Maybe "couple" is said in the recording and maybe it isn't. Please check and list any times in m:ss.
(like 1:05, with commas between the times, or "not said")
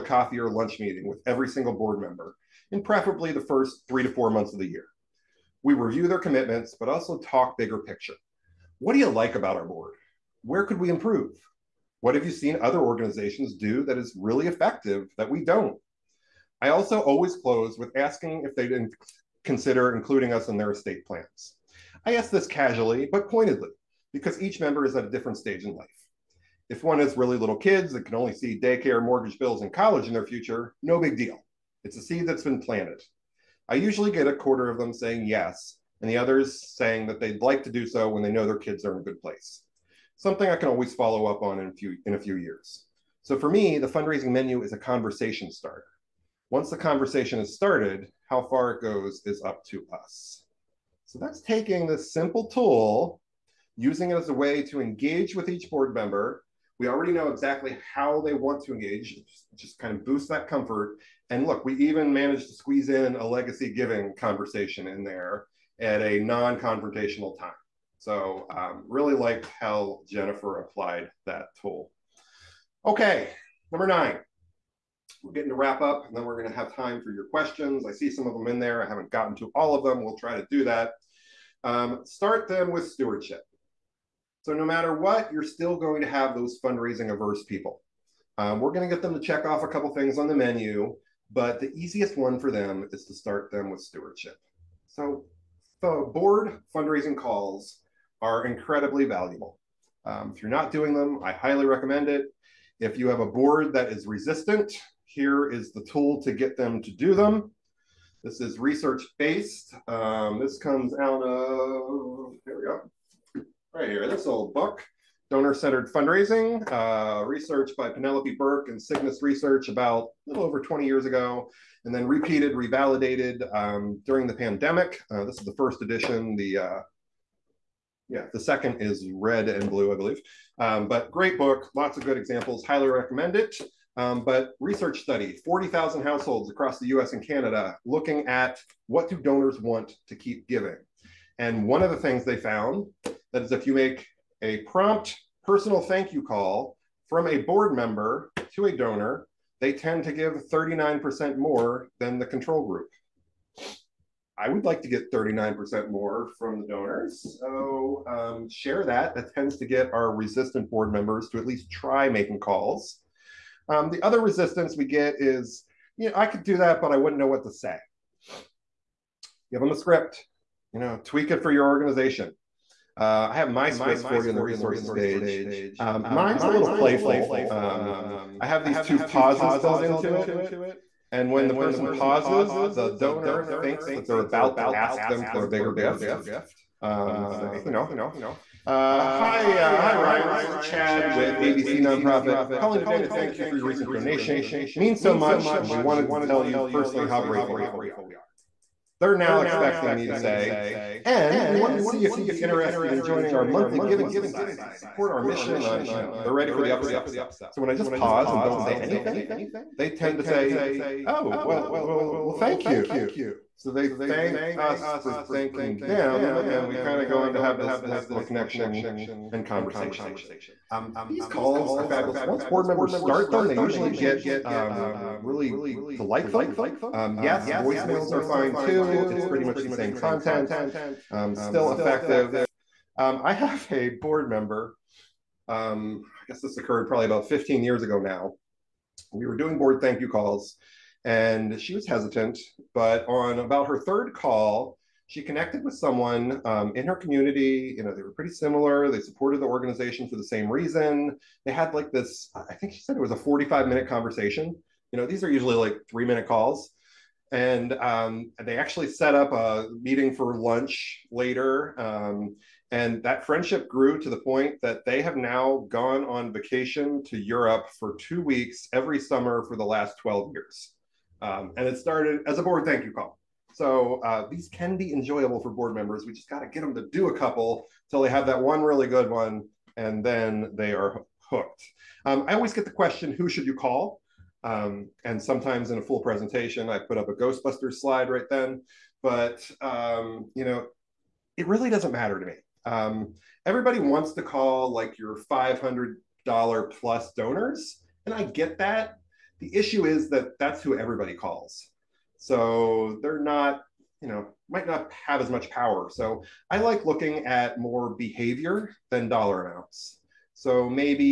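1:29, 4:37.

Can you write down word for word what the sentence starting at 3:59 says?
We were doing board thank you calls, and she was hesitant.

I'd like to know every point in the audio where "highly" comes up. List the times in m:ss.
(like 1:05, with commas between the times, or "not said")
1:41, 2:12.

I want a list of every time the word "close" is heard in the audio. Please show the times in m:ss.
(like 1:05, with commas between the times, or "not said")
0:17.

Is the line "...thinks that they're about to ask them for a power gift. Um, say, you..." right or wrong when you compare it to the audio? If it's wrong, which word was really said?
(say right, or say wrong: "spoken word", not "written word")
wrong: "bigger", not "power".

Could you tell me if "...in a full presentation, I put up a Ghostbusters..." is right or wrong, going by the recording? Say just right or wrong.
right.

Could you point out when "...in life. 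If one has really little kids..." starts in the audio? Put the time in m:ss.
0:25.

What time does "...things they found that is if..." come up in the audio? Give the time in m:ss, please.
2:21.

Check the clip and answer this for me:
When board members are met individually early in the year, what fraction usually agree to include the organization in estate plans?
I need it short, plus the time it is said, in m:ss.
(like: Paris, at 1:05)
a quarter, at 0:34.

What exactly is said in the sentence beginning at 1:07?
So, um, really liked how Jennifer applied that tool.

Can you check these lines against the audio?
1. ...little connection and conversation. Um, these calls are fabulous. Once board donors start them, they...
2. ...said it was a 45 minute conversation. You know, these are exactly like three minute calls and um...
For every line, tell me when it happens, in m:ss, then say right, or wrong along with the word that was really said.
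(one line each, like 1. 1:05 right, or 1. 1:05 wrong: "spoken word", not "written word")
1. 3:38 wrong: "members", not "donors"
2. 4:12 wrong: "usually", not "exactly".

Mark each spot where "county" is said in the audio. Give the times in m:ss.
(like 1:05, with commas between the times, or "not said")
not said.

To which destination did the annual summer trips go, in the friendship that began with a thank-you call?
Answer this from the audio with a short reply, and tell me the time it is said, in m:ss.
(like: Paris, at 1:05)
Europe, at 4:27.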